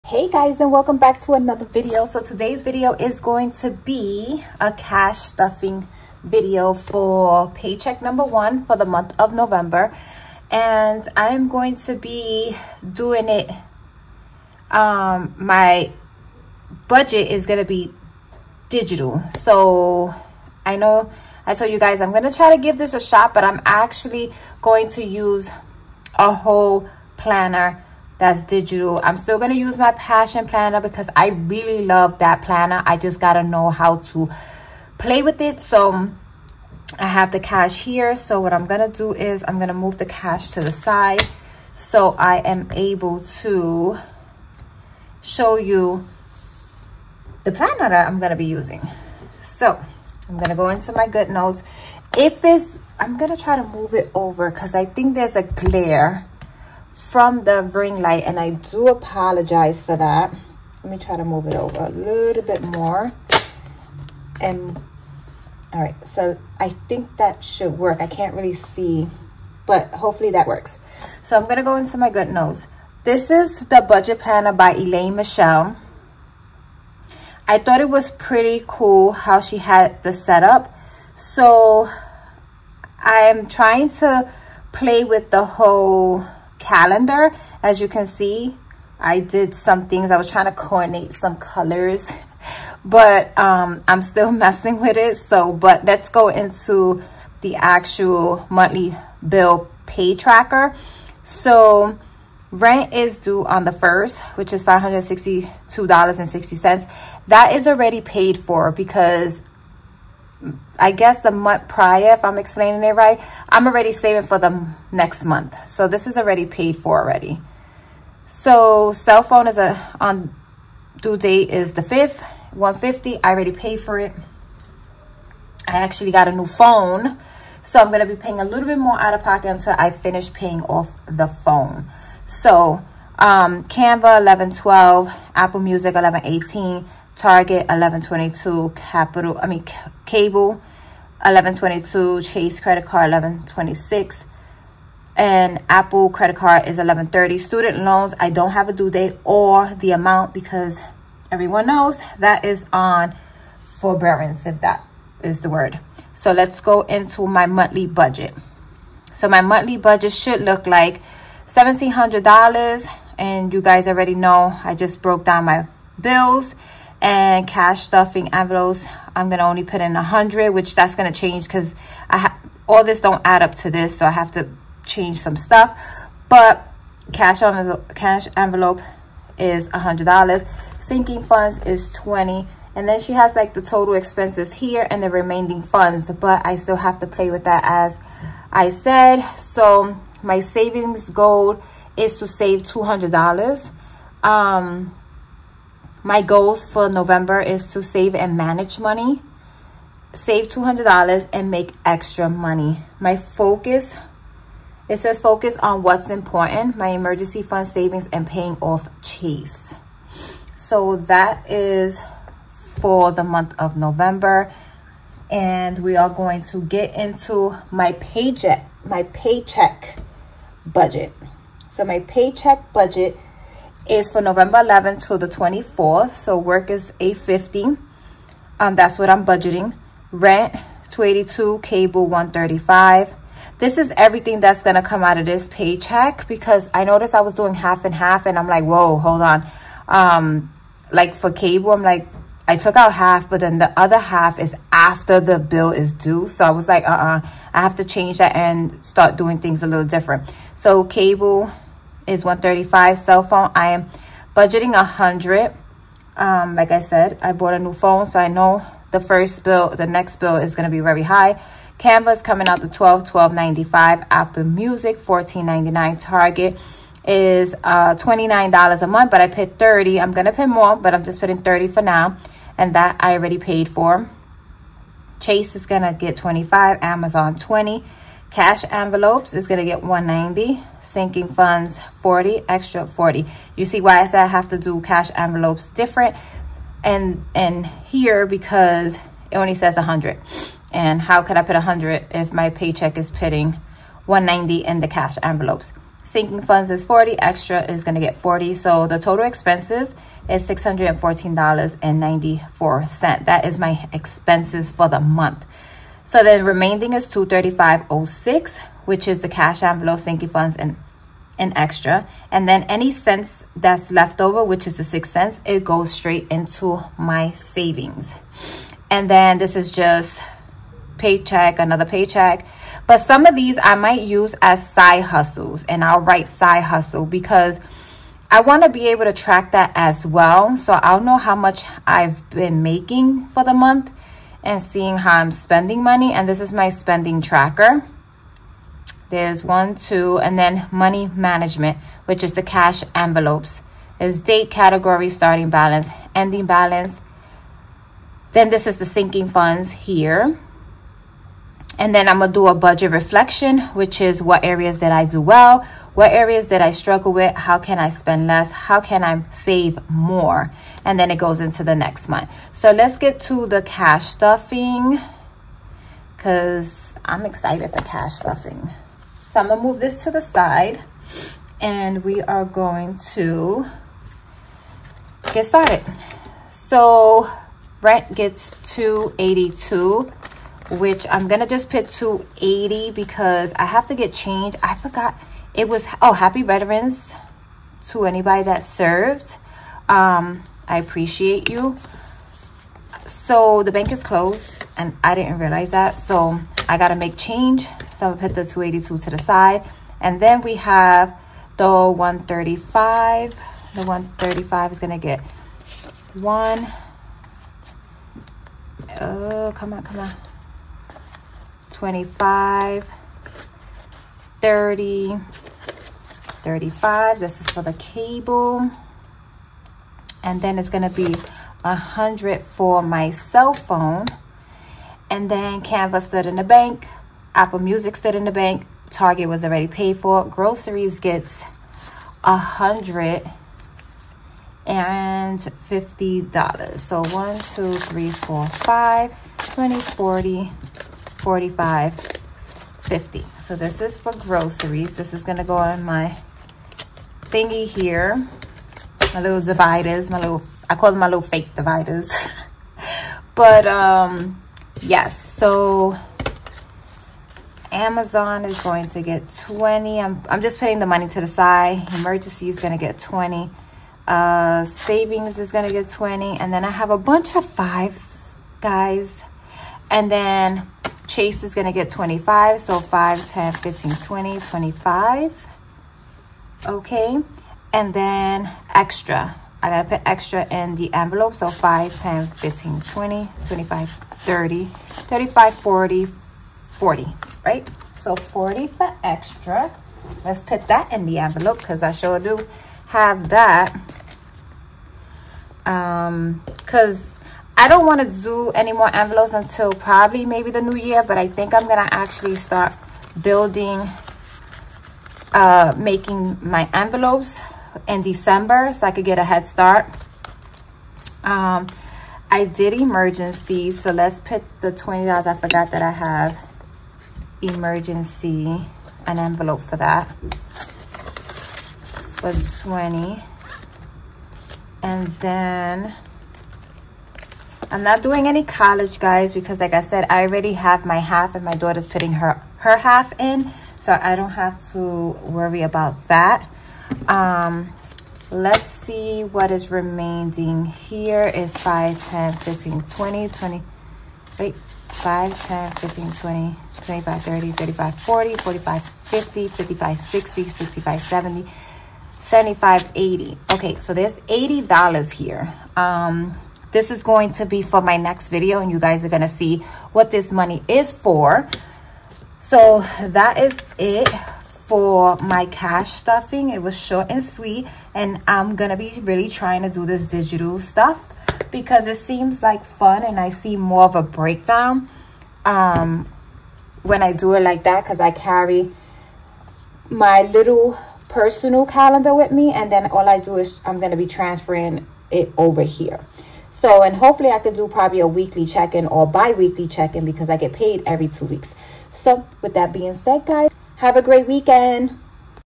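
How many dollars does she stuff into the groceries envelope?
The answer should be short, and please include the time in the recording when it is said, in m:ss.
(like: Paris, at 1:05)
150, at 7:12.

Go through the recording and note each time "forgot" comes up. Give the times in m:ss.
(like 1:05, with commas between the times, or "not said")
6:24, 8:35.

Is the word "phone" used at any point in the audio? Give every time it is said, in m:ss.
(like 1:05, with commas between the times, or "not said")
1:59, 2:06, 2:11, 4:13, 4:17, 7:03.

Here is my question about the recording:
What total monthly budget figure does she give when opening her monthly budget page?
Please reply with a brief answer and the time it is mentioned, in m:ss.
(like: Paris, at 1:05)
$1,700, at 2:41.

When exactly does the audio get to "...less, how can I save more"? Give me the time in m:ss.
5:58.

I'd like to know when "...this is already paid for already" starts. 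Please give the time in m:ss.
1:55.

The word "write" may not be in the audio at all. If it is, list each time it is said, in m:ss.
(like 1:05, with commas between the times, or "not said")
5:26.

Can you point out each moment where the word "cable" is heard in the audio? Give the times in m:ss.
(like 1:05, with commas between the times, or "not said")
2:20, 3:51, 4:01, 4:10, 6:57.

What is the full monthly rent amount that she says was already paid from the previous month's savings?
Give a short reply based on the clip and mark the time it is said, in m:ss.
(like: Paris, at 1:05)
$562.60, at 1:44.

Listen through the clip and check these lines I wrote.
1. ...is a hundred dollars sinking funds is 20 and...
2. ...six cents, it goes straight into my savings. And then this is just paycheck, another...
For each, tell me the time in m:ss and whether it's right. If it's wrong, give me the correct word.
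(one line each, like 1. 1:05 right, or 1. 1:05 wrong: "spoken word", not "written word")
1. 2:59 right
2. 5:14 right.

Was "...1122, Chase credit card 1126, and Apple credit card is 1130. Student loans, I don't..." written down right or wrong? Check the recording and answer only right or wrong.
right.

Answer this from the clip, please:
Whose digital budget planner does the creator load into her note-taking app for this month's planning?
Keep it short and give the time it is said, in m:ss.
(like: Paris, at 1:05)
Elaine Michelle, at 1:14.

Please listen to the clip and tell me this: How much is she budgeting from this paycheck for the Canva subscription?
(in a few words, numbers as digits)
12.95.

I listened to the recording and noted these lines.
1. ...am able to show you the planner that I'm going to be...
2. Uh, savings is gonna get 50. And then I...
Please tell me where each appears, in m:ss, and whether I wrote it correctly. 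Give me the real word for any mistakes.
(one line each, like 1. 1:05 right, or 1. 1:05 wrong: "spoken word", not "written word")
1. 0:42 right
2. 7:44 wrong: "20", not "50".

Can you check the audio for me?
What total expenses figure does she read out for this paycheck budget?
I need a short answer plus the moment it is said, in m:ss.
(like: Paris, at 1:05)
$614.94, at 5:00.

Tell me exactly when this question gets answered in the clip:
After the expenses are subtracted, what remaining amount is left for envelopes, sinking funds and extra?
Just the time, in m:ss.
5:07.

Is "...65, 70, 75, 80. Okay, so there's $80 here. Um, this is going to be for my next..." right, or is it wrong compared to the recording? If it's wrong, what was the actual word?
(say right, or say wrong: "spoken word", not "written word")
right.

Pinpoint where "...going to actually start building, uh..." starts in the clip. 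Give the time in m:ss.
8:21.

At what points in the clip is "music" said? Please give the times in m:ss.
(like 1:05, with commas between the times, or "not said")
2:15, 4:24, 7:07.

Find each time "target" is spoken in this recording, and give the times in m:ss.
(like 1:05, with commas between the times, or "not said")
2:17, 4:26, 7:08.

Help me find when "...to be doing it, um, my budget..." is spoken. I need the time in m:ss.
0:11.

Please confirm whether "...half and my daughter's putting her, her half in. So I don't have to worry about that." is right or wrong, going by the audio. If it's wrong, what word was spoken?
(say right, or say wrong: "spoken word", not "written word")
right.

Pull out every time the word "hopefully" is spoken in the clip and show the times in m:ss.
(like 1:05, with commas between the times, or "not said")
1:09, 9:46.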